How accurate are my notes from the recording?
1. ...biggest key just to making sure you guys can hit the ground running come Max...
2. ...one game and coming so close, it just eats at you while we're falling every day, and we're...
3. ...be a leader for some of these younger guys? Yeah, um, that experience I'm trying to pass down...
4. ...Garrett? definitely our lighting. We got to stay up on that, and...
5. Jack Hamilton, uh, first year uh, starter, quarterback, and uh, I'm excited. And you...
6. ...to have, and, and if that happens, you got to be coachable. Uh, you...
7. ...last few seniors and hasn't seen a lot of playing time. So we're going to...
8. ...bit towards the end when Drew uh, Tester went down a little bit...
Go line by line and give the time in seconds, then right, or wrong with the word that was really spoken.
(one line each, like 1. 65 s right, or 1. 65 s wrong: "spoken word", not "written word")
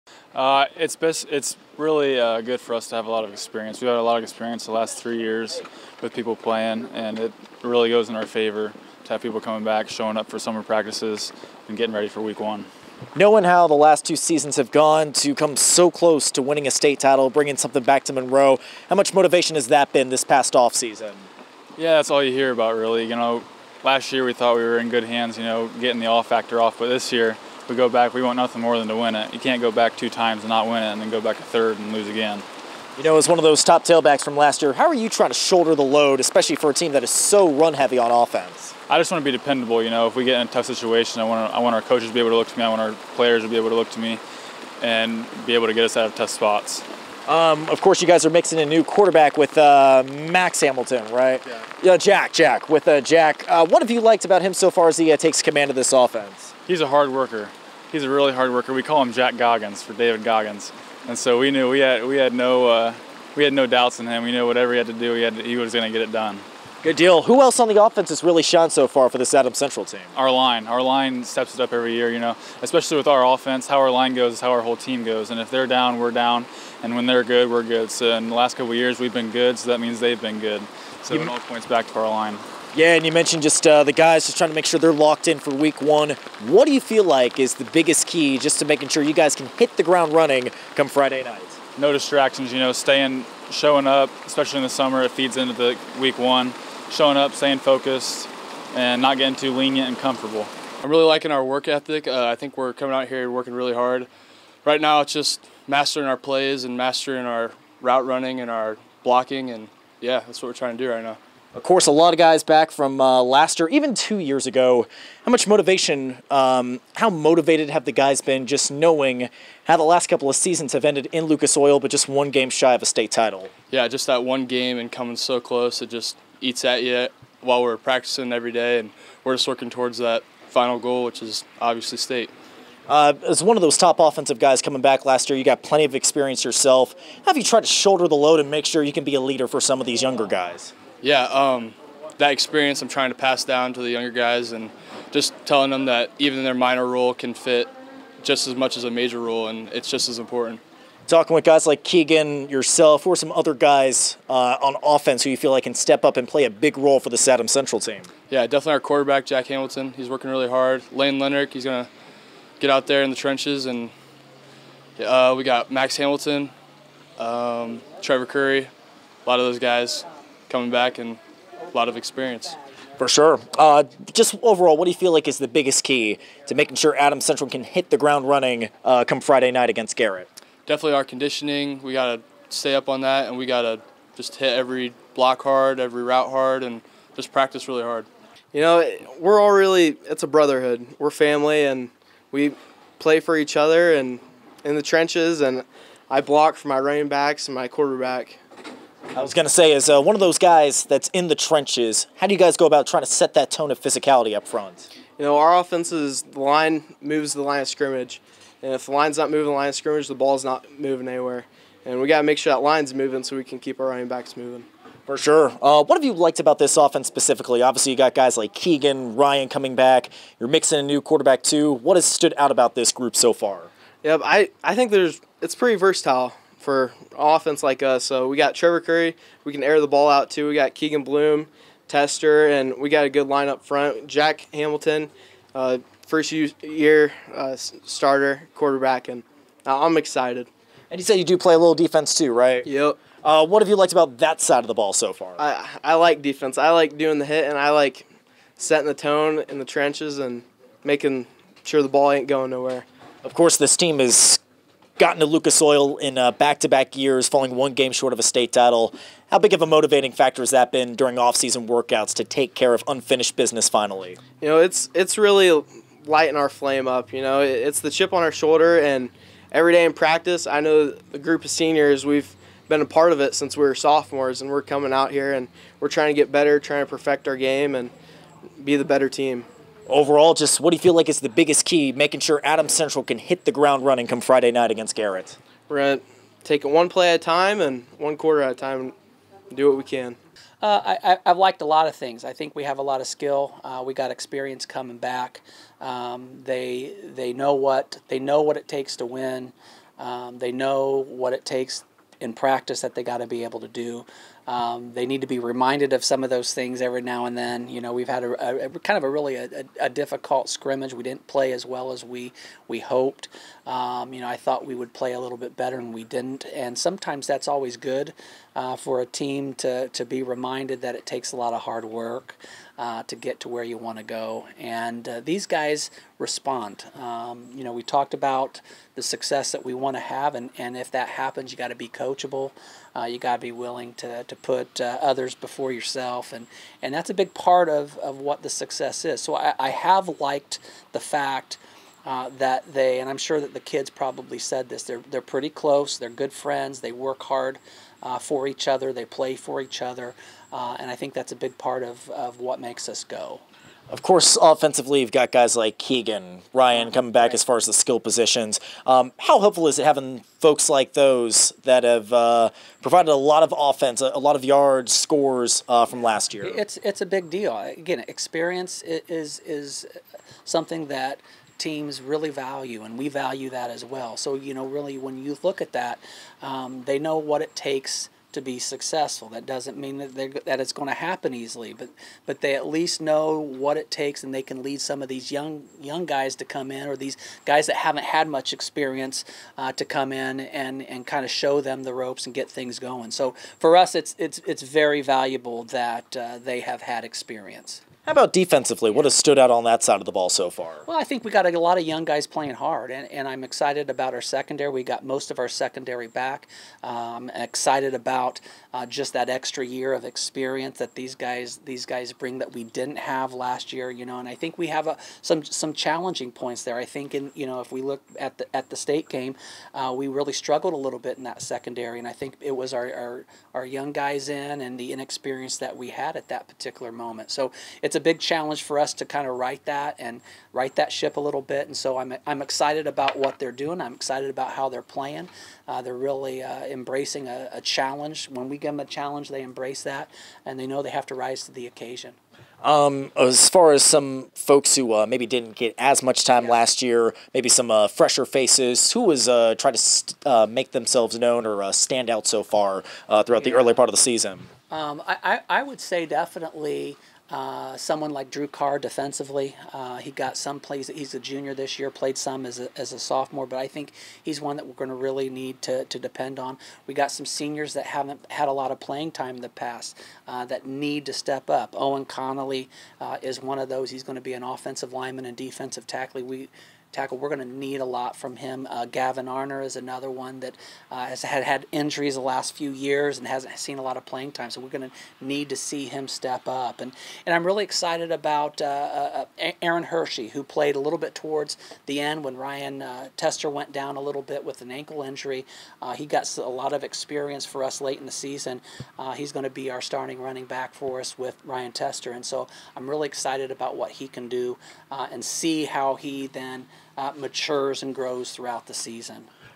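1. 87 s wrong: "Friday", not "Max"
2. 124 s wrong: "practicing", not "falling"
3. 139 s right
4. 179 s wrong: "conditioning", not "lighting"
5. 234 s right
6. 329 s right
7. 482 s wrong: "years", not "seniors"
8. 490 s wrong: "Ryan", not "Drew".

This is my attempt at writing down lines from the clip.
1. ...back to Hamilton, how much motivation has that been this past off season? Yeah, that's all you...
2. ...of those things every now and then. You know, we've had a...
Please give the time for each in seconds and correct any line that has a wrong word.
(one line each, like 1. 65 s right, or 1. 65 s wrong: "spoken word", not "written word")
1. 17 s wrong: "Monroe", not "Hamilton"
2. 306 s right.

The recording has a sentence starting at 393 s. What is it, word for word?
So for us, it's it's it's very valuable that uh, they have had experience.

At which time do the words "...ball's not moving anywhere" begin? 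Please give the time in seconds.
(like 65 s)
210 s.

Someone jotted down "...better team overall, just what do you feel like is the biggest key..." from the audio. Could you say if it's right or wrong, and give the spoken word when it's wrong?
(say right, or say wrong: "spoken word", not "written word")
right.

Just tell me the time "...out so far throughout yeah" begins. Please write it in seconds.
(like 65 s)
452 s.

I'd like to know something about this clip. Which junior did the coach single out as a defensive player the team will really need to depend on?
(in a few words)
Drew Carr.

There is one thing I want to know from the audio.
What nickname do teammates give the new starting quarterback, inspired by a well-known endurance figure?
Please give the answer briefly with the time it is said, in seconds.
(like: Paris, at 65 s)
Jack Goggins, at 59 s.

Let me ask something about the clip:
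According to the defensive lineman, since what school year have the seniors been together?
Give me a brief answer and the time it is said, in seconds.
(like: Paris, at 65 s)
sophomores, at 273 s.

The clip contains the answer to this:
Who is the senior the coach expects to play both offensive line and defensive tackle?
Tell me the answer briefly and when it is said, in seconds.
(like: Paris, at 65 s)
Owen Connolly, at 471 s.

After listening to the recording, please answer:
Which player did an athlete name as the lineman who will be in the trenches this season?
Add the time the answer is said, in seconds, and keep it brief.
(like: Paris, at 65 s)
Lain Lengerich, at 160 s.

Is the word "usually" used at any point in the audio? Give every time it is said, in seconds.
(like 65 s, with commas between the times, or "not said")
not said.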